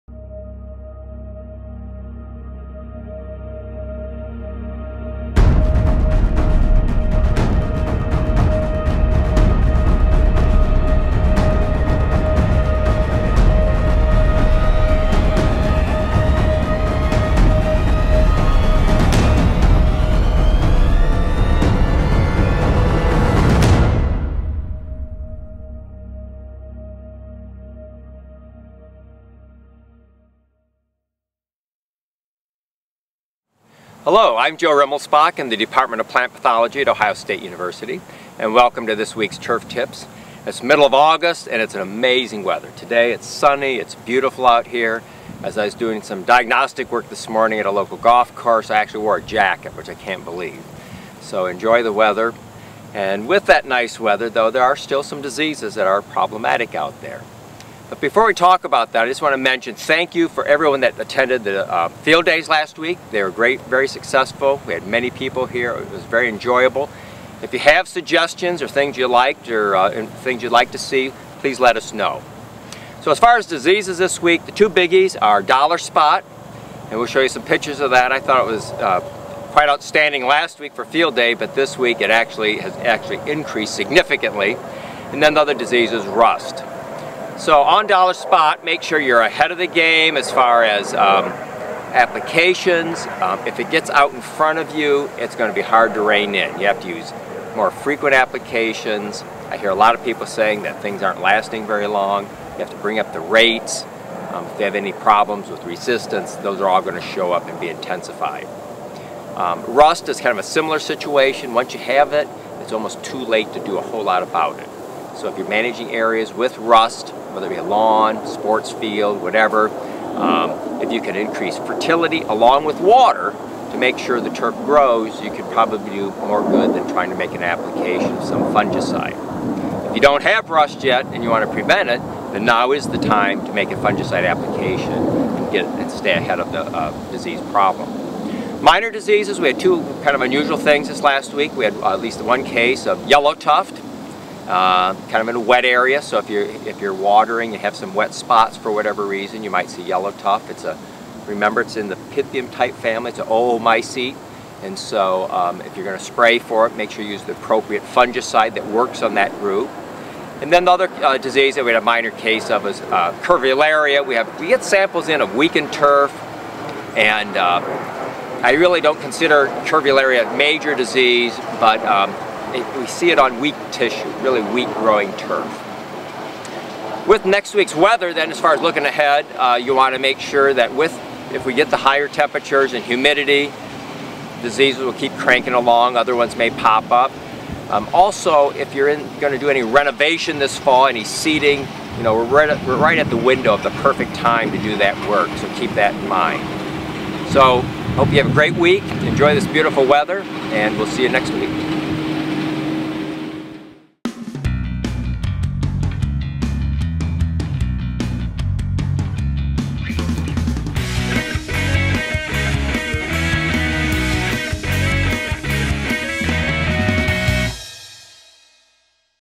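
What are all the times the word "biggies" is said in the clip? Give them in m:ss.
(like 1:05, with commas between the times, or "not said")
1:14.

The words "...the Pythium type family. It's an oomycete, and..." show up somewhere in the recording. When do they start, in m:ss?
2:31.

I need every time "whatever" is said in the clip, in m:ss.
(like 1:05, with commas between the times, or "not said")
1:59, 2:28.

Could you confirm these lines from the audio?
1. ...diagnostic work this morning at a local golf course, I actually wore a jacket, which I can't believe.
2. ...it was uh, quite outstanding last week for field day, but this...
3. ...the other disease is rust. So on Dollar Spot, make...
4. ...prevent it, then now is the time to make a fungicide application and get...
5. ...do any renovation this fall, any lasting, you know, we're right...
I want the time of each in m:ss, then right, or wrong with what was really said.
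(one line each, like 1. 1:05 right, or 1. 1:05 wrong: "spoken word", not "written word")
1. 0:46 right
2. 1:18 right
3. 1:25 right
4. 2:11 right
5. 3:09 wrong: "seeding", not "lasting".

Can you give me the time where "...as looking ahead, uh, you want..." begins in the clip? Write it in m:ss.
2:58.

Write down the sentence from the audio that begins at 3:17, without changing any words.
So, hope you have a great week, enjoy this beautiful weather, and we'll see you next week.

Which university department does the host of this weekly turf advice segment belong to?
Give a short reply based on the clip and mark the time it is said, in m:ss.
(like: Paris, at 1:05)
Plant Pathology, at 0:36.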